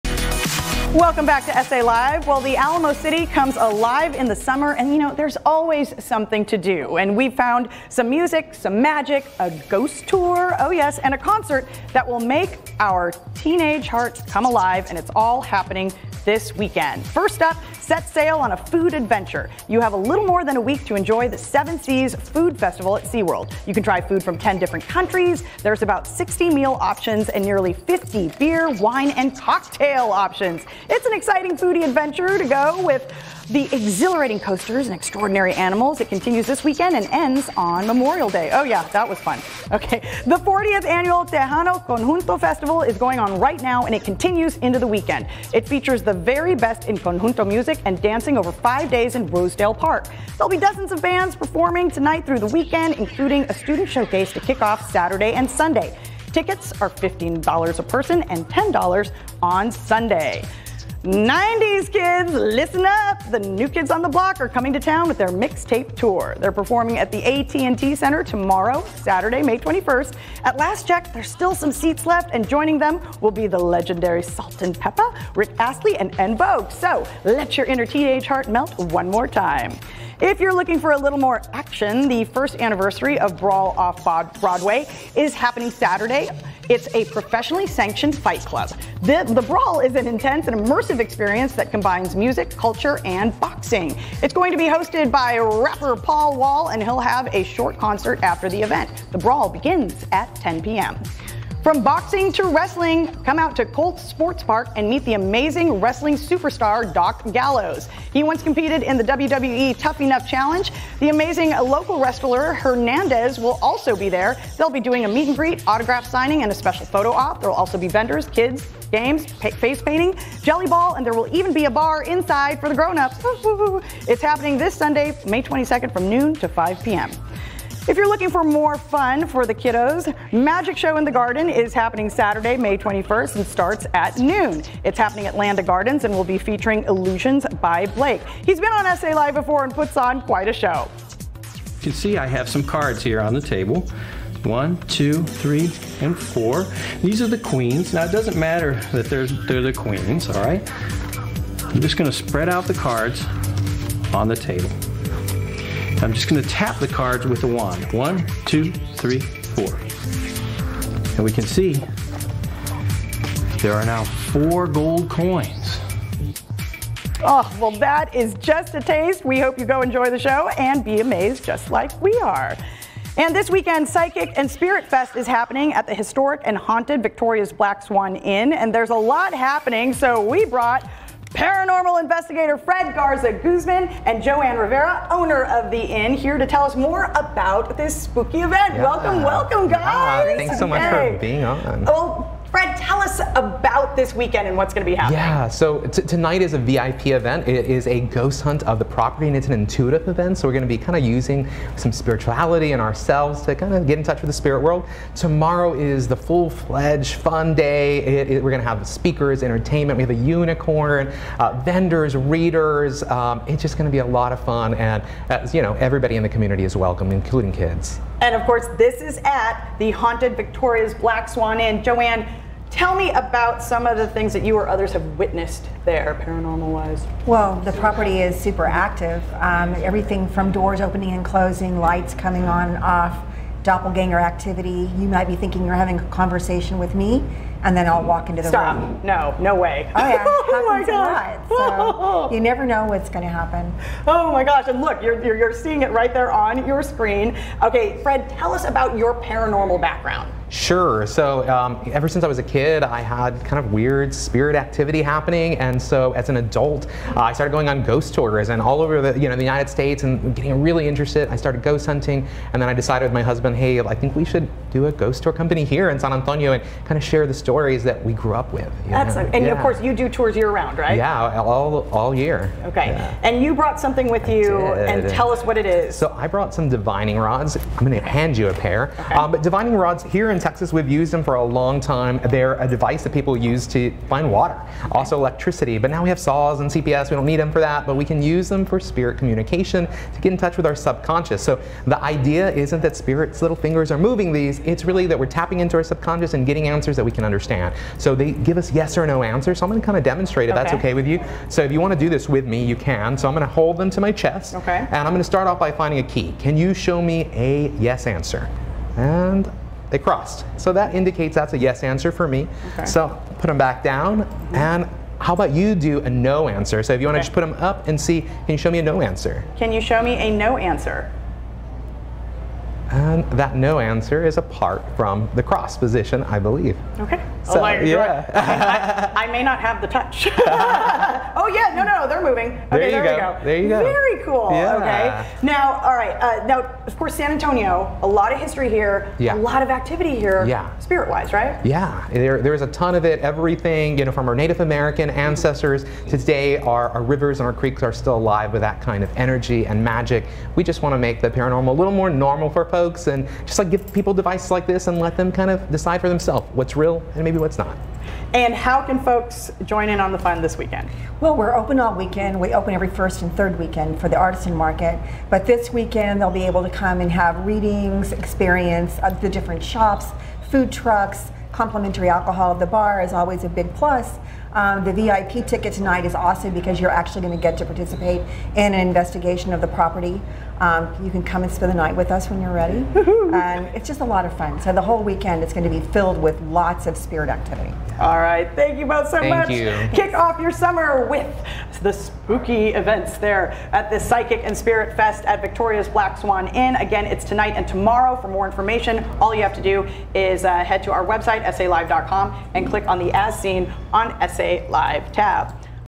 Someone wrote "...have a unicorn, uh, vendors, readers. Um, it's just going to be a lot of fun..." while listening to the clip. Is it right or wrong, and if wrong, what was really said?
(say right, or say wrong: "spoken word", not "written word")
right.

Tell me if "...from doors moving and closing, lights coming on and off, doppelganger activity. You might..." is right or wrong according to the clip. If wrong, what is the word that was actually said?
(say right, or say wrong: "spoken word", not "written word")
wrong: "opening", not "moving".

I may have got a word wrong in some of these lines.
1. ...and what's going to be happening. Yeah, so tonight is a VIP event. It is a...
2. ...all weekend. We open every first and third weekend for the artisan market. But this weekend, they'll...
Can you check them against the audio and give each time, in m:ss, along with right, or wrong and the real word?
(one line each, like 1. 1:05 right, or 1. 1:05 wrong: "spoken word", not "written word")
1. 3:14 right
2. 6:01 right.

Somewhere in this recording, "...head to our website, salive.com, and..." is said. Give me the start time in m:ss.
6:40.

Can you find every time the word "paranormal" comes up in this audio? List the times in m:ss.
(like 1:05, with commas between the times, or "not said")
3:01, 3:46, 4:09, 5:51.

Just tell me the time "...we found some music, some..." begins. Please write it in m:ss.
0:07.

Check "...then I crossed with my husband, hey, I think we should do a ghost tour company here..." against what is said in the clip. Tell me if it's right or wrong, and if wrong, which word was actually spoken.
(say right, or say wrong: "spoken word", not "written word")
wrong: "decided", not "crossed".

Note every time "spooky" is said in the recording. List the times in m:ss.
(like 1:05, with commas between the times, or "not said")
3:08, 6:31.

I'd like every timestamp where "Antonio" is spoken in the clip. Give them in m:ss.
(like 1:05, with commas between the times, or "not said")
4:26, 5:37.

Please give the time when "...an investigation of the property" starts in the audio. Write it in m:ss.
6:18.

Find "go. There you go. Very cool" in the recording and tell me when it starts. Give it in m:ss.
5:33.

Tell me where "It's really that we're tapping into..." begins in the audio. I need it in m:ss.
4:54.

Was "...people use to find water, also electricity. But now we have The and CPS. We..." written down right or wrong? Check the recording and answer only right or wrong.
wrong.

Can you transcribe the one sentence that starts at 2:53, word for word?
And this weekend, Psychic and Spirit Fest is happening at the historic and haunted Victoria's Black Swan Inn.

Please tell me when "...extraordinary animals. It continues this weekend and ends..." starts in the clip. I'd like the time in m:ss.
0:34.